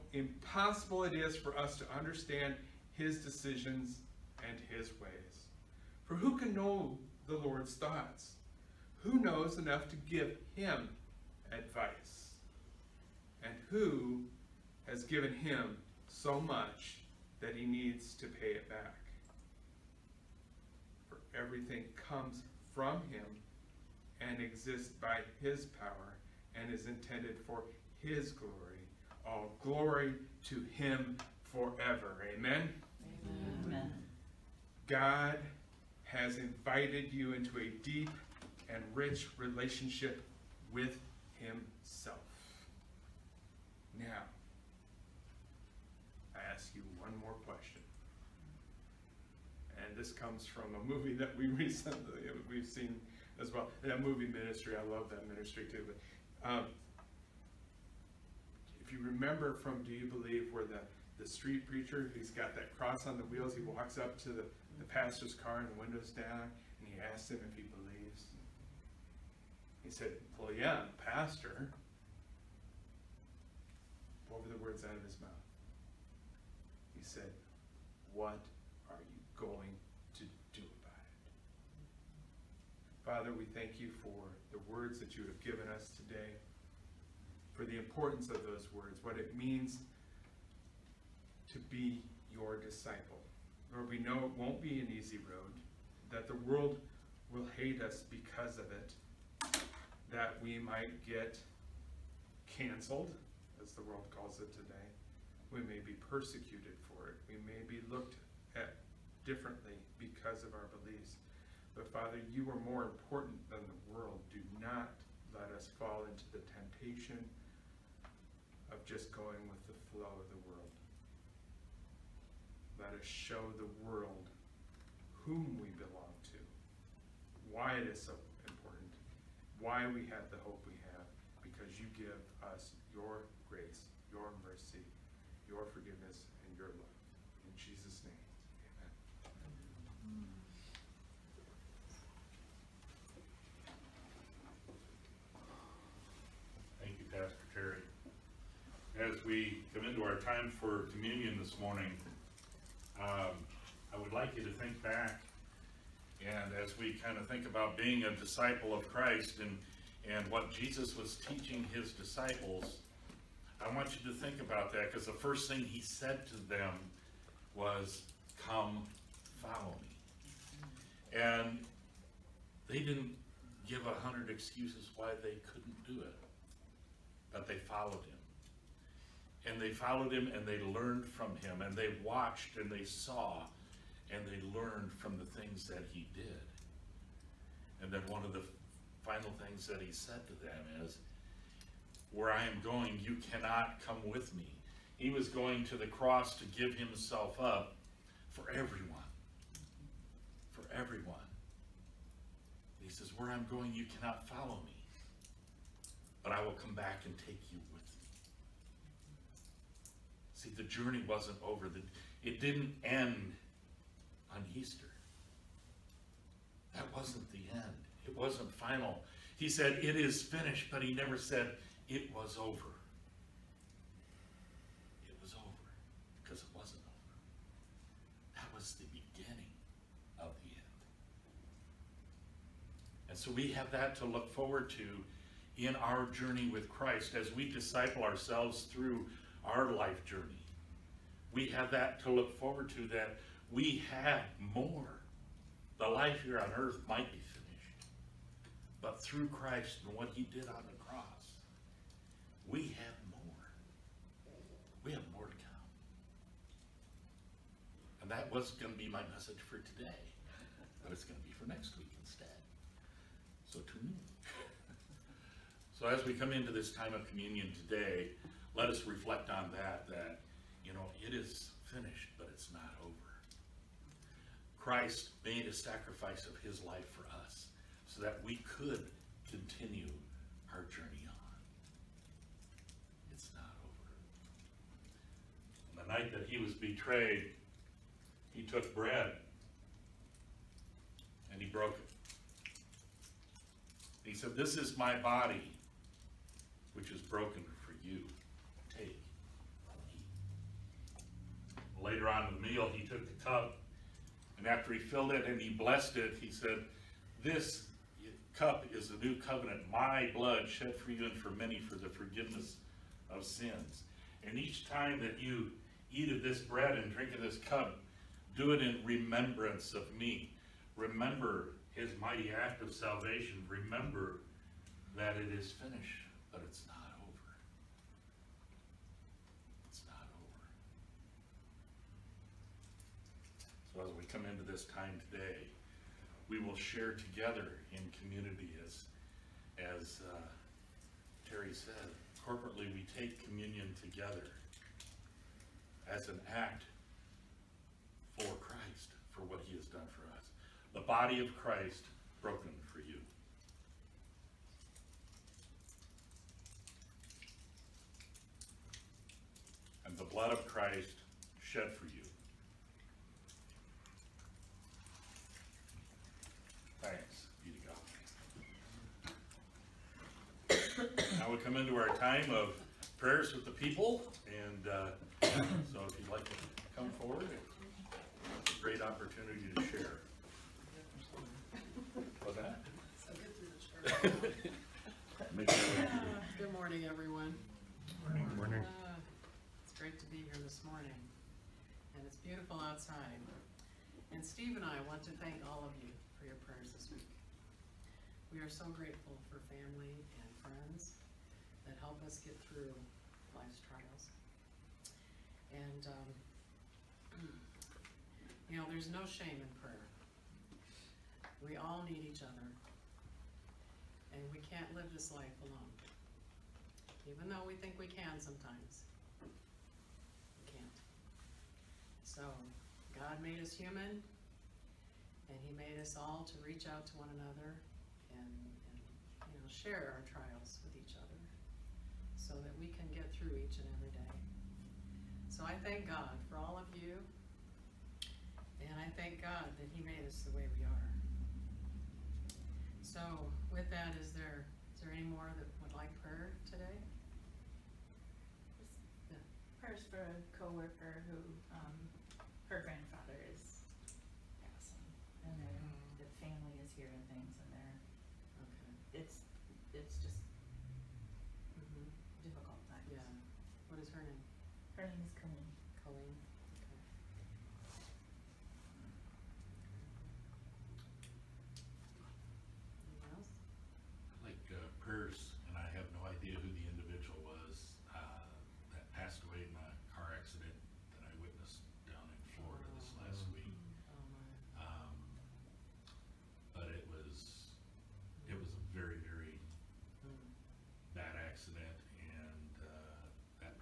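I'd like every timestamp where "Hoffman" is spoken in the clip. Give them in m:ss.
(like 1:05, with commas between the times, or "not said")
not said.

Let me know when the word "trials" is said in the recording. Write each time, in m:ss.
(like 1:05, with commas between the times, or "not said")
6:43, 7:10.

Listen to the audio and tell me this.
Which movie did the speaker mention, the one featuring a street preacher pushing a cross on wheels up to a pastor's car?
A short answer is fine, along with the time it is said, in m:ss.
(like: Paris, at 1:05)
Do You Believe, at 0:59.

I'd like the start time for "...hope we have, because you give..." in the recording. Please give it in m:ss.
2:10.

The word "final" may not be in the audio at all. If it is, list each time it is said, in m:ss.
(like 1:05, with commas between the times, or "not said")
3:09, 3:38.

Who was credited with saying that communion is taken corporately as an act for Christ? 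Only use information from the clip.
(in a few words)
Terry.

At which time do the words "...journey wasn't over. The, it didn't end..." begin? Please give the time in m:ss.
3:30.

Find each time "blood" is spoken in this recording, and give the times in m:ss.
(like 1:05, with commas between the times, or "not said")
5:10, 6:00.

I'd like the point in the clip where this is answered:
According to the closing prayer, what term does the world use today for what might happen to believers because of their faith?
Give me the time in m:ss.
1:42.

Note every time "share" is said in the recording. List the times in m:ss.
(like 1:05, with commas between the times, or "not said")
5:36, 6:19, 7:09.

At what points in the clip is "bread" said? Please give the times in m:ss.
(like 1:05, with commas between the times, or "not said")
4:48, 5:16.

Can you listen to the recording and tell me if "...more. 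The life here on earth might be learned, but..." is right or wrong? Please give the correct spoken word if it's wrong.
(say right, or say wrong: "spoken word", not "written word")
wrong: "finished", not "learned".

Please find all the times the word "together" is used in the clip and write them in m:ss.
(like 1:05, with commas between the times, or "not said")
5:36, 5:43.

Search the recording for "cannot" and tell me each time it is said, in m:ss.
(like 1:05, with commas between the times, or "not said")
3:13, 3:23.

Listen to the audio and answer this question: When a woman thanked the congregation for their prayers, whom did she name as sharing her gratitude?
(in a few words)
Steve.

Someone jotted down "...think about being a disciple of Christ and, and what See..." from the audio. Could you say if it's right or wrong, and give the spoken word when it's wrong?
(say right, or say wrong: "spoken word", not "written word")
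wrong: "Jesus", not "See".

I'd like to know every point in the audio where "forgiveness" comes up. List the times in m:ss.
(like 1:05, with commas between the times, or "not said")
2:15, 5:11.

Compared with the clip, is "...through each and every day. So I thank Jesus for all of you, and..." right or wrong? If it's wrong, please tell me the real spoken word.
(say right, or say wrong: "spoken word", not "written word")
wrong: "God", not "Jesus".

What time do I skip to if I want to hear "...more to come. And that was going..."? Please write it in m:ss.
4:15.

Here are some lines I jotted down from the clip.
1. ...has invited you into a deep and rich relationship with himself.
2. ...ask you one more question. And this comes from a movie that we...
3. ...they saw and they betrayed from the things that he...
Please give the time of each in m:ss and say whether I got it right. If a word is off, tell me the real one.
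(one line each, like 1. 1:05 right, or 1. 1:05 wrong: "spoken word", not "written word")
1. 0:36 right
2. 0:46 right
3. 3:02 wrong: "learned", not "betrayed".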